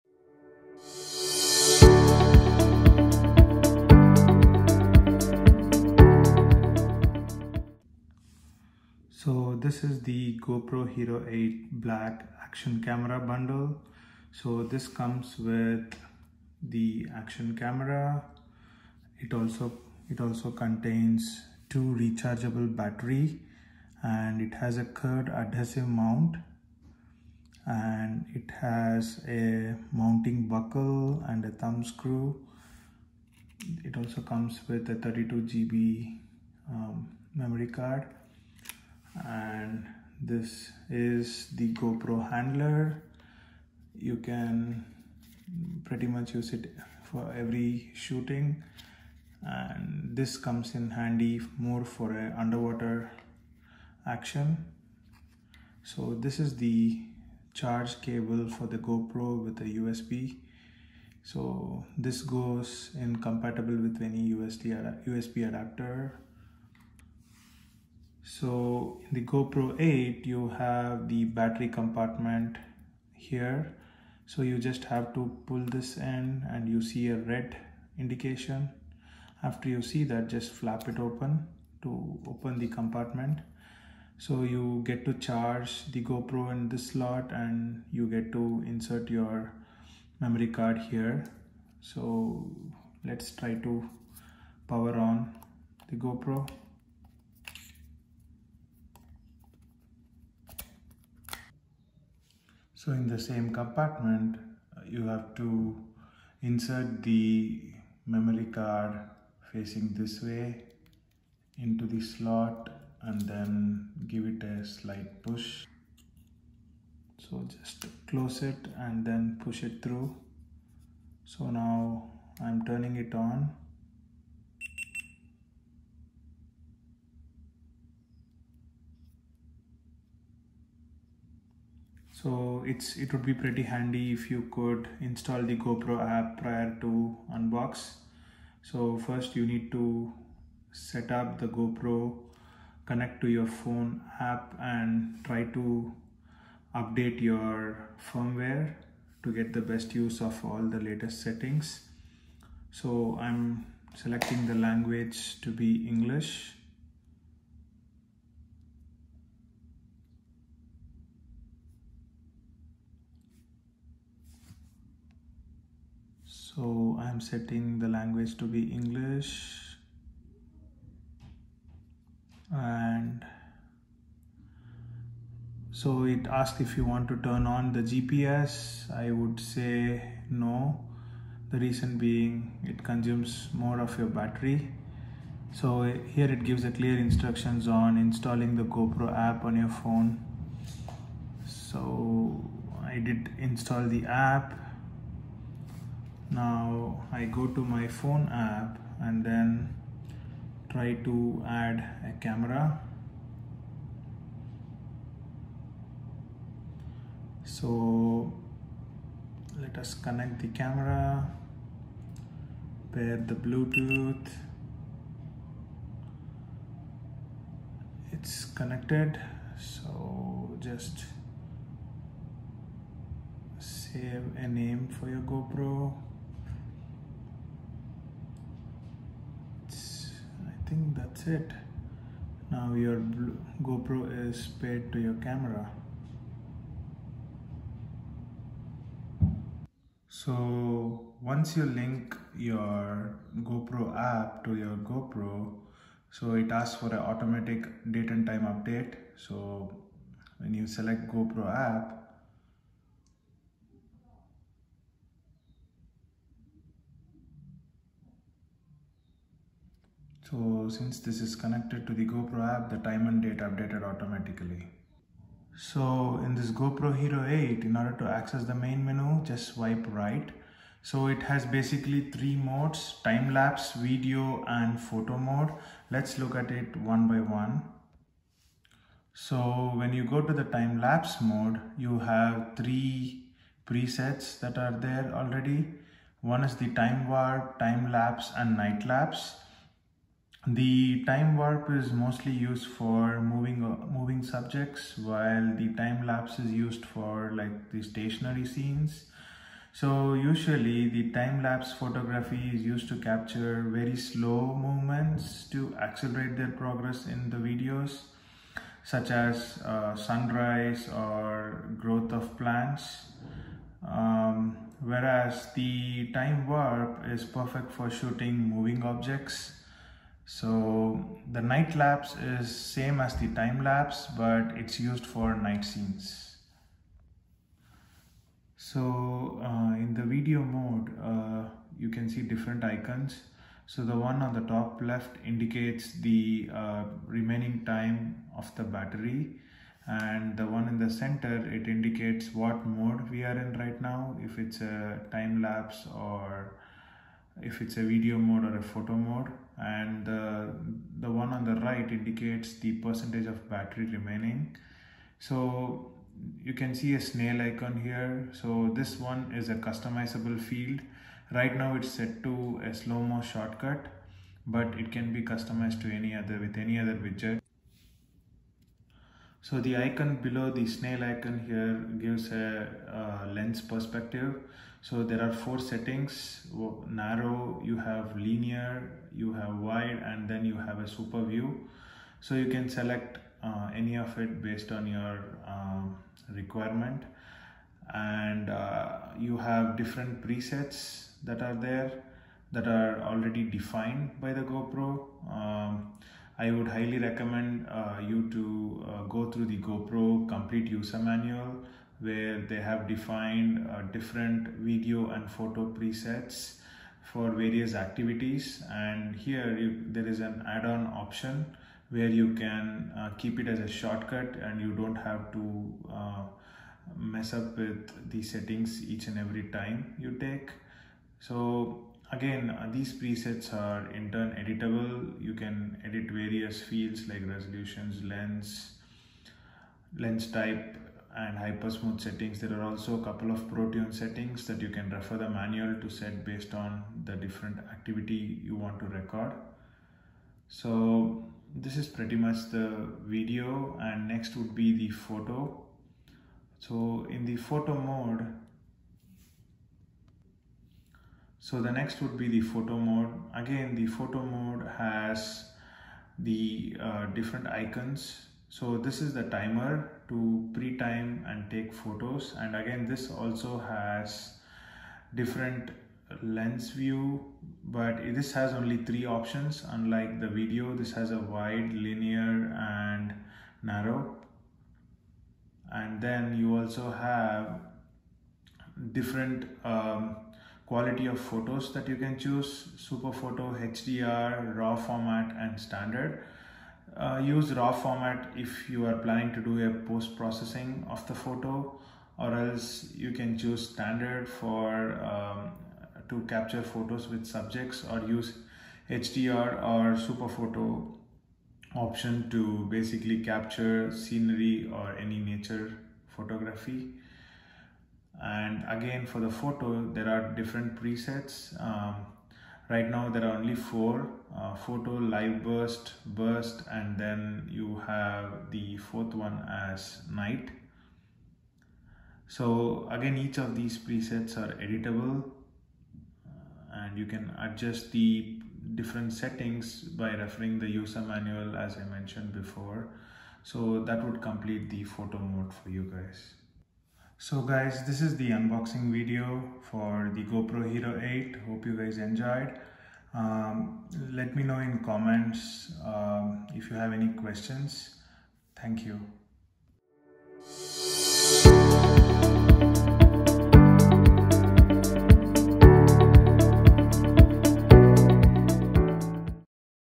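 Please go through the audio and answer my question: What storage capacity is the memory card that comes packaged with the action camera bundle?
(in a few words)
32 GB.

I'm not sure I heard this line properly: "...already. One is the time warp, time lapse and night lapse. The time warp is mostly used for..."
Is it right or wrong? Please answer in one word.
right.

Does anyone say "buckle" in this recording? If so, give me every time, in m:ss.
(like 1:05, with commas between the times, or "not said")
0:30.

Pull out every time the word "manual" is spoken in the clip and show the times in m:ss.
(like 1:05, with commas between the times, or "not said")
6:40, 7:15, 8:51.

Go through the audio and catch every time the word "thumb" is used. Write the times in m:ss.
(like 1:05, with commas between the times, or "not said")
0:31.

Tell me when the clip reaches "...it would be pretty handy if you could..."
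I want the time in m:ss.
2:12.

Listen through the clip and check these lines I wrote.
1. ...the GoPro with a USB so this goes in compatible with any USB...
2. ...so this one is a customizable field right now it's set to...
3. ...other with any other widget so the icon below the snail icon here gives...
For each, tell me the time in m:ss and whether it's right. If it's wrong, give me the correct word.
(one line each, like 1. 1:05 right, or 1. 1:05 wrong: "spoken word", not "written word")
1. 0:58 right
2. 5:58 right
3. 6:06 right.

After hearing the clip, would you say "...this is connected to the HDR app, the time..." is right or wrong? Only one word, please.
wrong.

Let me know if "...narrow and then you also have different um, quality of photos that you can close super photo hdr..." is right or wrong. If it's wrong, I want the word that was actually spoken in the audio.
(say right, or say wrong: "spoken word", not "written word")
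wrong: "choose", not "close".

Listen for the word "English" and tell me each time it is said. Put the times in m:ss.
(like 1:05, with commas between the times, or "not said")
2:35, 2:48.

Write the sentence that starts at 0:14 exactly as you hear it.
So this comes with the action camera.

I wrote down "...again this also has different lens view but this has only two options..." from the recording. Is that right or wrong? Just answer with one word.
wrong.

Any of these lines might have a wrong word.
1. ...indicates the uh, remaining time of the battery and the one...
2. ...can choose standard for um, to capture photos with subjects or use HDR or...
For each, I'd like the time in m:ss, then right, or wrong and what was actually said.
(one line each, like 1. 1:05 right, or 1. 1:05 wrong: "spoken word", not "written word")
1. 5:35 right
2. 8:13 right.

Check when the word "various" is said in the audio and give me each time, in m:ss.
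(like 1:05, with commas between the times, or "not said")
6:47, 7:06.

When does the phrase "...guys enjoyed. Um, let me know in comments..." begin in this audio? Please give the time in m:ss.
9:01.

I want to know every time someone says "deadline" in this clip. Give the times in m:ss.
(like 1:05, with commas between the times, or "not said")
not said.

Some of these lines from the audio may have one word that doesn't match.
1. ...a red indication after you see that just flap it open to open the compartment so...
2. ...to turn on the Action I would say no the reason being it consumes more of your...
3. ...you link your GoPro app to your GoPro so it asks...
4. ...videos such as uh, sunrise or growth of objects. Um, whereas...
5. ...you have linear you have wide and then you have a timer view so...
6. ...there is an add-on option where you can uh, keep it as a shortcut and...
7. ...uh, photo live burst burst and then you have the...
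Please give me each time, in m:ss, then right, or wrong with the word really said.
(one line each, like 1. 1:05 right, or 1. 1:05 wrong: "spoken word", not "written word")
1. 1:17 right
2. 2:57 wrong: "GPS", not "Action"
3. 4:01 right
4. 5:07 wrong: "plants", not "objects"
5. 6:17 wrong: "super", not "timer"
6. 6:49 right
7. 8:34 right.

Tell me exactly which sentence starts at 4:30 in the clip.
So it has basically three modes, time lapse, video and photo mode.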